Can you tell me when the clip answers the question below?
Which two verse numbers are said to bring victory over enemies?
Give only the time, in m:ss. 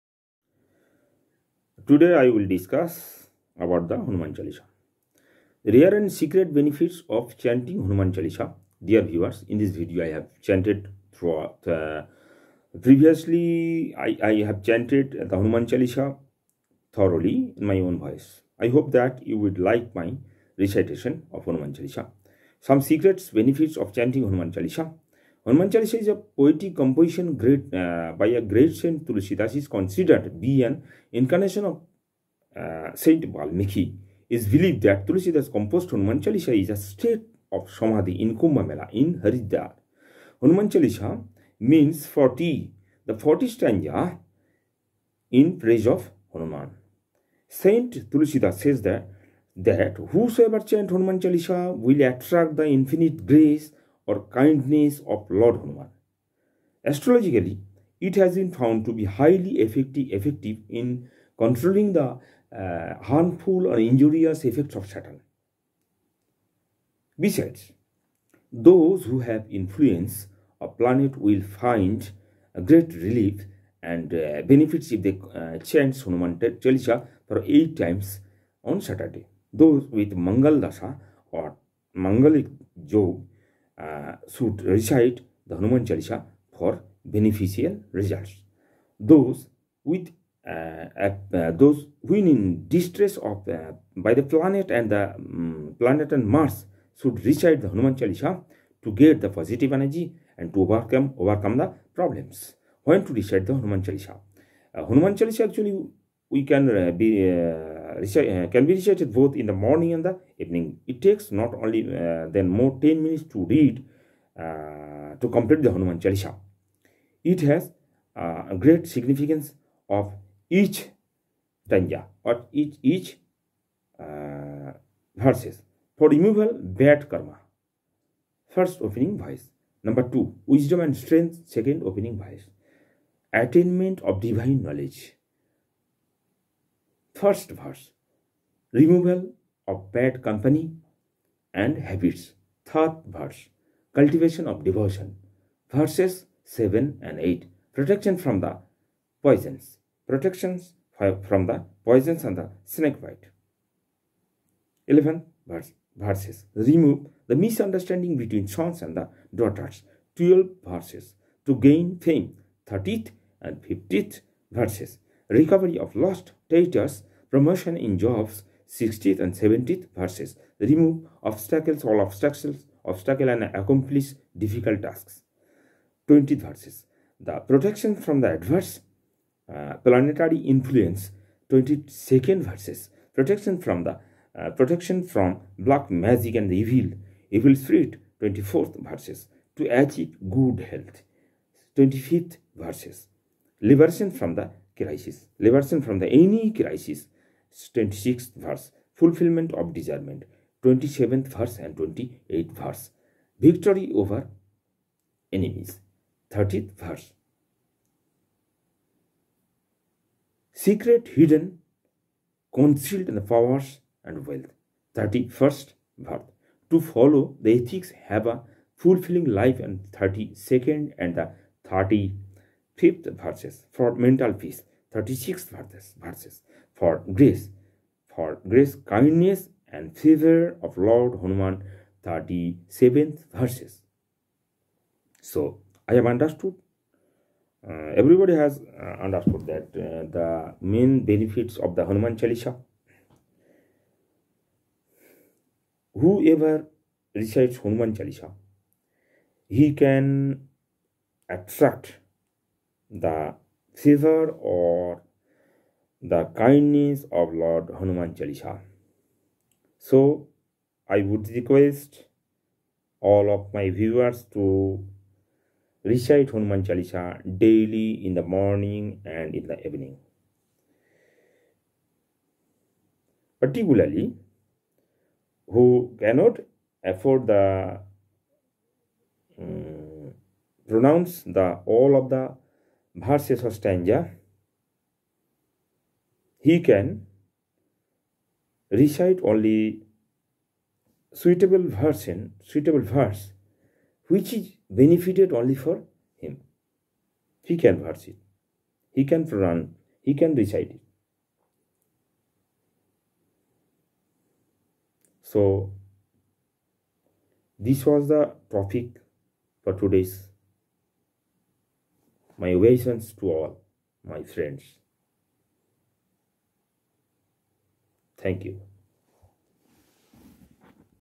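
3:20.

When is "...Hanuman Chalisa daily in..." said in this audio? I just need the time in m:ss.
4:26.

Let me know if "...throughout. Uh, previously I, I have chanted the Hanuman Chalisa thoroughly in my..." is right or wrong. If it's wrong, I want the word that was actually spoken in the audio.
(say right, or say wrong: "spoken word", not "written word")
right.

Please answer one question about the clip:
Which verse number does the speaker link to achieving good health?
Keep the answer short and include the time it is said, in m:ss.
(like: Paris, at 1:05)
25th, at 3:11.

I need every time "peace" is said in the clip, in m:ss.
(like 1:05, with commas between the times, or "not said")
3:44.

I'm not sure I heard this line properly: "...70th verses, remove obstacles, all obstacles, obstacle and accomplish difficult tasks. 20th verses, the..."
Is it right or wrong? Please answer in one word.
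right.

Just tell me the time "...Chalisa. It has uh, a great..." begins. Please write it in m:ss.
1:55.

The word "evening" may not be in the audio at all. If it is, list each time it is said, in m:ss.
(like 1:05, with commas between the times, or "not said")
1:50, 4:29.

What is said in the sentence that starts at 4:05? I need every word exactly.
Whoever recites Hanuman Chalisa, he can attract the Caesar or the kindness of Lord Hanuman Chalisa.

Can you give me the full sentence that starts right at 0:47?
Saint Tulsidas says that that whosoever chant Hanuman Chalisa will attract the infinite grace or kindness of Lord Hanuman.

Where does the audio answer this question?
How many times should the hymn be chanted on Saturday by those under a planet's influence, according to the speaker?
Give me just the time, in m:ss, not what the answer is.
1:17.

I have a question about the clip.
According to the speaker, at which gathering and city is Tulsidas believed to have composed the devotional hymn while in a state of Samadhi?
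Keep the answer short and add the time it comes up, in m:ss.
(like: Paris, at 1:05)
Kumbh Mela in Haridwar, at 0:38.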